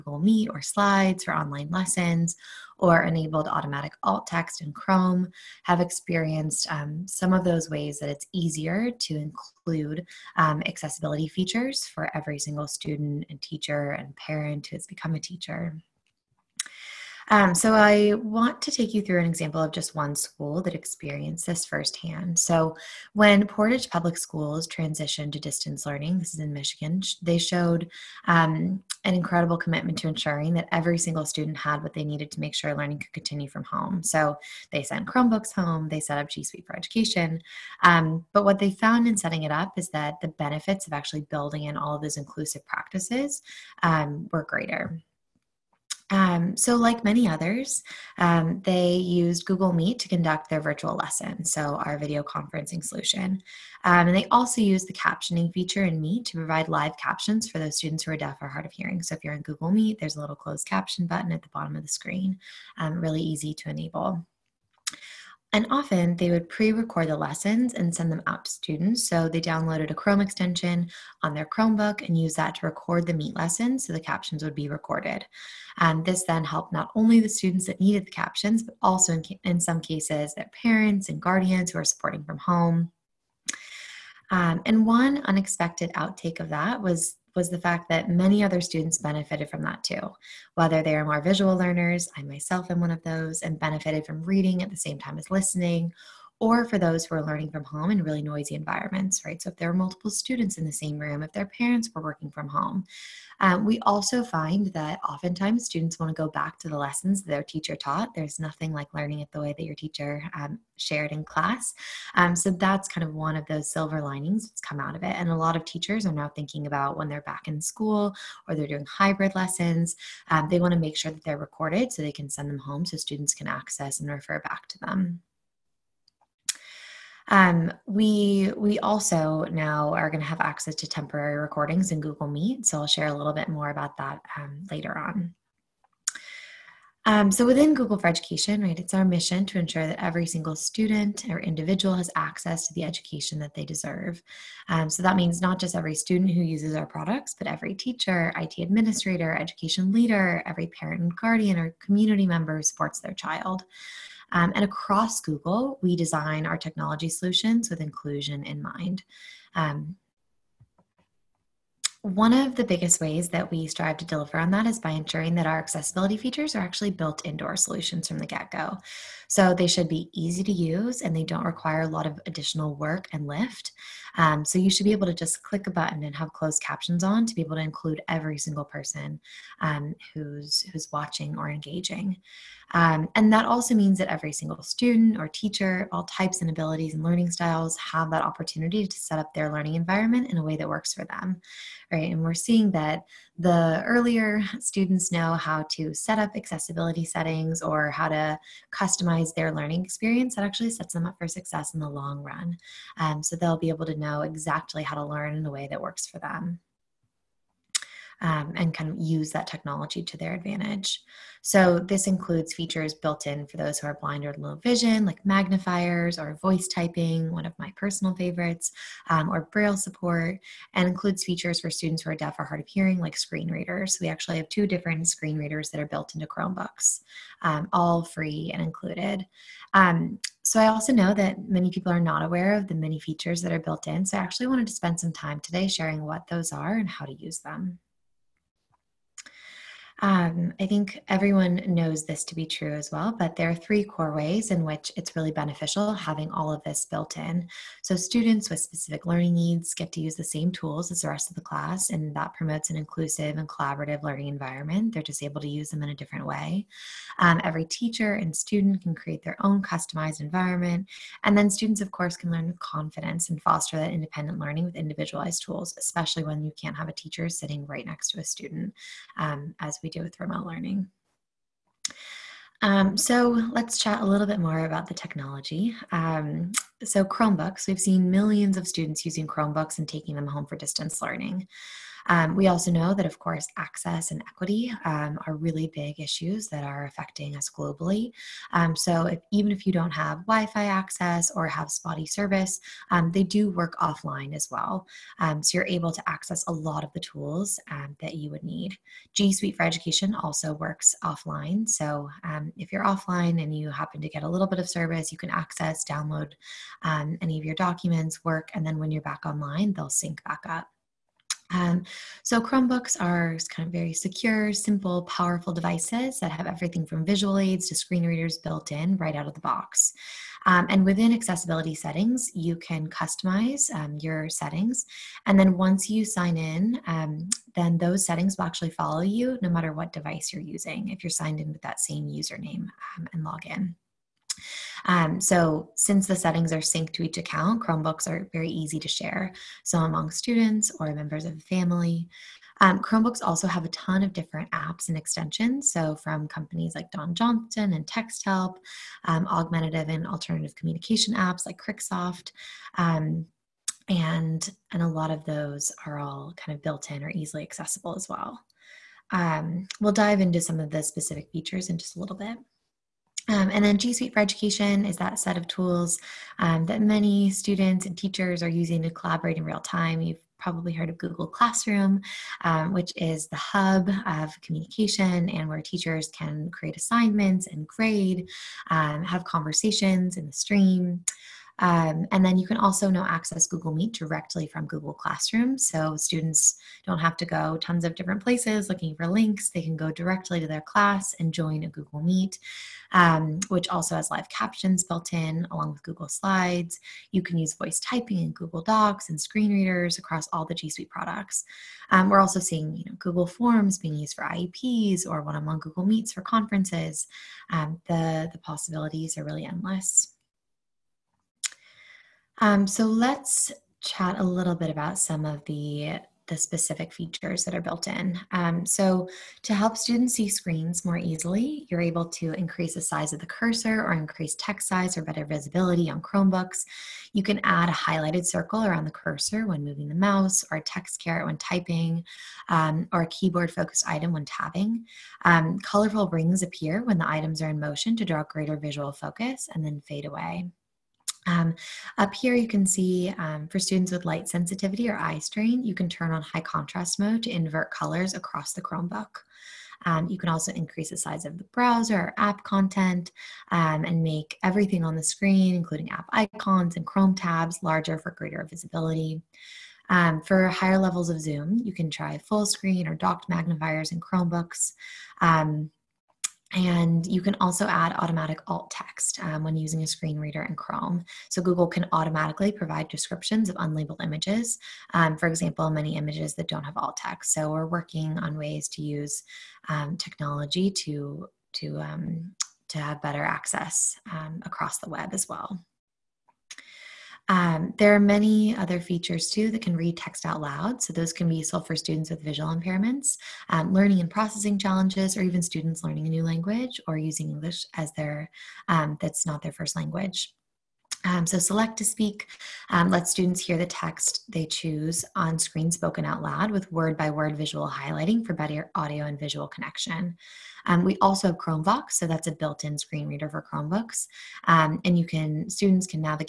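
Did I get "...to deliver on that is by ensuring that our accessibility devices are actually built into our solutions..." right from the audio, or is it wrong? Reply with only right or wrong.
wrong.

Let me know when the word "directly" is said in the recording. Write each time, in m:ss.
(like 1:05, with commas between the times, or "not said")
6:23, 6:29.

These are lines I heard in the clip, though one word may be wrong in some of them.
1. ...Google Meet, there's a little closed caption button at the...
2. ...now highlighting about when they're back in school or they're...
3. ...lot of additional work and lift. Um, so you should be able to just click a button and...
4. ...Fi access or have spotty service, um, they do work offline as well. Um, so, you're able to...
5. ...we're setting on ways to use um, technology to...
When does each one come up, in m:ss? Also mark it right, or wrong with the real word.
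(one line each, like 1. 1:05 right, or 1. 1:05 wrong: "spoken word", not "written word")
1. 0:59 right
2. 1:56 wrong: "thinking", not "highlighting"
3. 2:51 right
4. 4:50 right
5. 7:57 wrong: "working", not "setting".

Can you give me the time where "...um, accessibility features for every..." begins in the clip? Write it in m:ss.
0:10.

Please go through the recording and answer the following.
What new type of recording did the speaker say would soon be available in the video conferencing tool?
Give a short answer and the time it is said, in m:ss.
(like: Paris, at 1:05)
temporary recordings, at 2:10.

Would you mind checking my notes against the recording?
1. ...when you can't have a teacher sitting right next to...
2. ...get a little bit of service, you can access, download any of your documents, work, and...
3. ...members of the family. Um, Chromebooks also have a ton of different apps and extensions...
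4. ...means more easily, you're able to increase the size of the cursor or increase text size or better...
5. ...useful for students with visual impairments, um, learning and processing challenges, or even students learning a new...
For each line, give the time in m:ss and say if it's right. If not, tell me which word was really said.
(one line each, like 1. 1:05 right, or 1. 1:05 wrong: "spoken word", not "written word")
1. 4:26 right
2. 5:04 right
3. 5:40 right
4. 7:00 wrong: "screens", not "means"
5. 8:11 right.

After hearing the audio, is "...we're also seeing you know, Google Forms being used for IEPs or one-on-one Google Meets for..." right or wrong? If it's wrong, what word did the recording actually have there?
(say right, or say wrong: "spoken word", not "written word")
right.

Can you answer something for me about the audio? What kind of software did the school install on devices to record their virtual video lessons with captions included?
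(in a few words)
Chrome extension.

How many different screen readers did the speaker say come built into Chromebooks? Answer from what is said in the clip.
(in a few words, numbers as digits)
2.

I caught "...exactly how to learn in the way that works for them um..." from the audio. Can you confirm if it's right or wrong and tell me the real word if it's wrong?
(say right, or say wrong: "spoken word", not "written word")
right.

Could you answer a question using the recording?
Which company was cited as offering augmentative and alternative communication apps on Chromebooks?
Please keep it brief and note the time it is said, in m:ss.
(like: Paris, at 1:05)
Cricksoft, at 5:51.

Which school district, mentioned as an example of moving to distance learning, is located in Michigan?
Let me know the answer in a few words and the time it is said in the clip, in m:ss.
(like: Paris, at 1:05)
Portage Public Schools, at 0:23.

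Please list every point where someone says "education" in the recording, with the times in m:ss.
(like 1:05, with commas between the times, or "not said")
0:36, 2:18, 2:22, 2:29, 4:59, 6:04.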